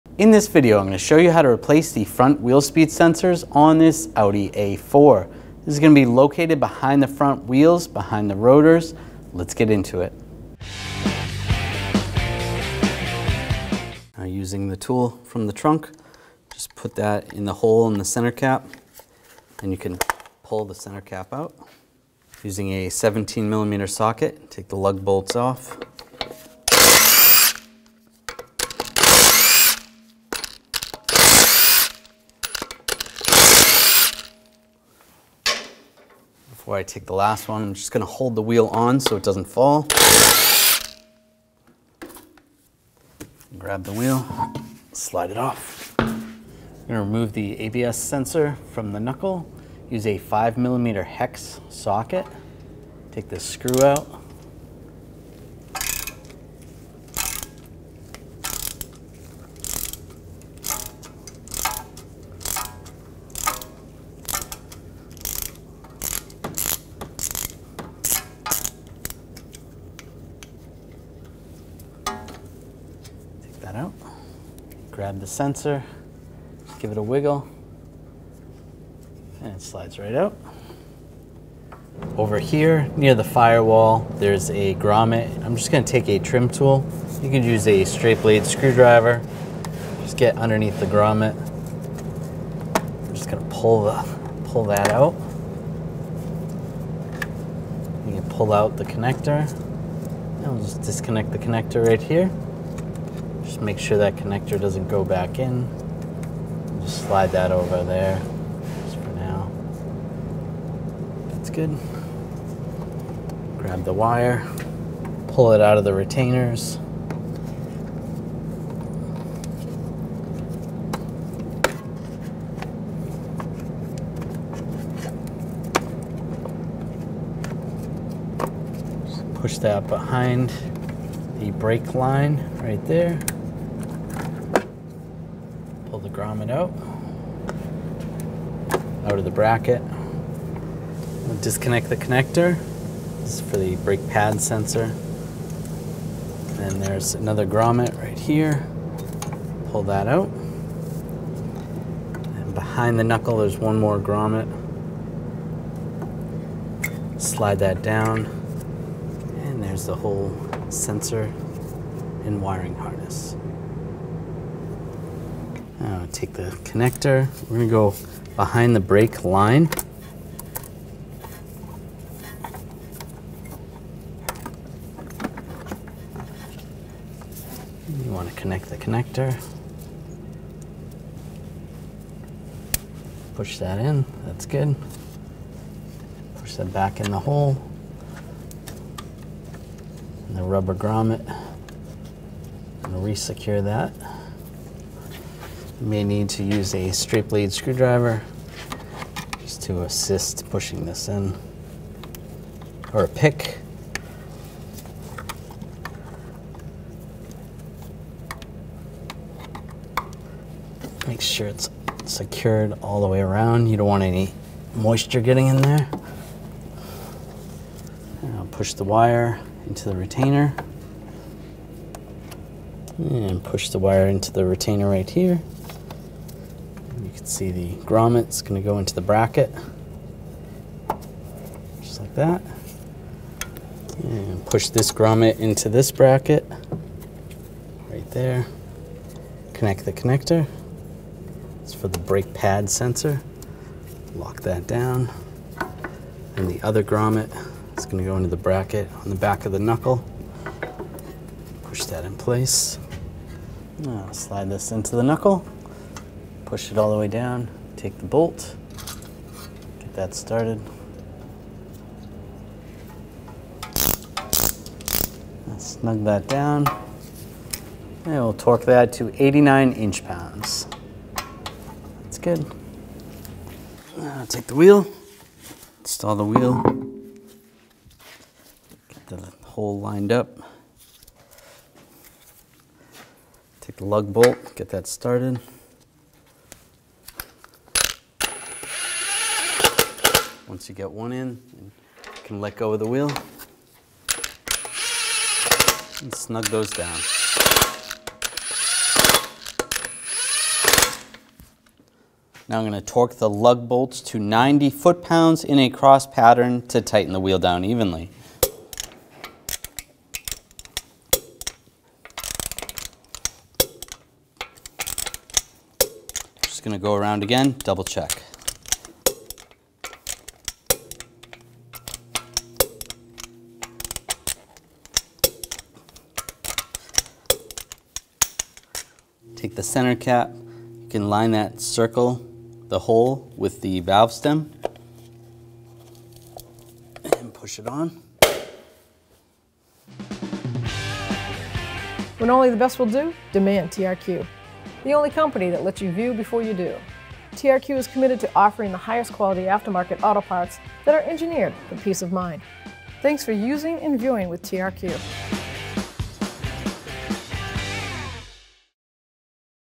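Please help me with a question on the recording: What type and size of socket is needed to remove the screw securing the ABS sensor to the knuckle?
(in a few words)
5 millimeter hex.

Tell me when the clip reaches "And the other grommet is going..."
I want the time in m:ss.
4:06.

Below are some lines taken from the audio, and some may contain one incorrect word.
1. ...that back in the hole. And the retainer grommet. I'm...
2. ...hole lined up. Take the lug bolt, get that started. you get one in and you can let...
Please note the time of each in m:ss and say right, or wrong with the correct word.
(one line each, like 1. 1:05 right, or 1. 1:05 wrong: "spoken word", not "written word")
1. 3:06 wrong: "rubber", not "retainer"
2. 4:39 right.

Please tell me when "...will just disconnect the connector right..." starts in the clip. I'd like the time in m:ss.
1:40.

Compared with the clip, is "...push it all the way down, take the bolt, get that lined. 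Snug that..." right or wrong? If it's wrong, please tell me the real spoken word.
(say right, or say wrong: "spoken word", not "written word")
wrong: "started", not "lined".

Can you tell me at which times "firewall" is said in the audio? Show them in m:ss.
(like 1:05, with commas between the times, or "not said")
1:23.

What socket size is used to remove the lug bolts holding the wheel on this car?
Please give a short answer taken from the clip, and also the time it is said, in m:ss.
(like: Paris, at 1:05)
17 millimeter, at 0:22.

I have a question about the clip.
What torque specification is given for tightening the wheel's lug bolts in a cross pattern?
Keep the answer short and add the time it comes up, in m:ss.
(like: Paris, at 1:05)
90 foot-pounds, at 5:04.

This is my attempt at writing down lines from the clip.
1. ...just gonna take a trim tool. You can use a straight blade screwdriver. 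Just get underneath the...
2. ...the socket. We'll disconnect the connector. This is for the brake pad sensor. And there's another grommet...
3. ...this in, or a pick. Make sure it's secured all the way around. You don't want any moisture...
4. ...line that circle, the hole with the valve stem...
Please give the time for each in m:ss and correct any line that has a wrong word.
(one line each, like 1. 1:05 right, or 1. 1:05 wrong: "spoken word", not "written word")
1. 1:25 right
2. 2:19 wrong: "bracket", not "socket"
3. 3:20 right
4. 5:31 right.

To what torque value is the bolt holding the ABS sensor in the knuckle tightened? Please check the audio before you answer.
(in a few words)
89 inch pounds.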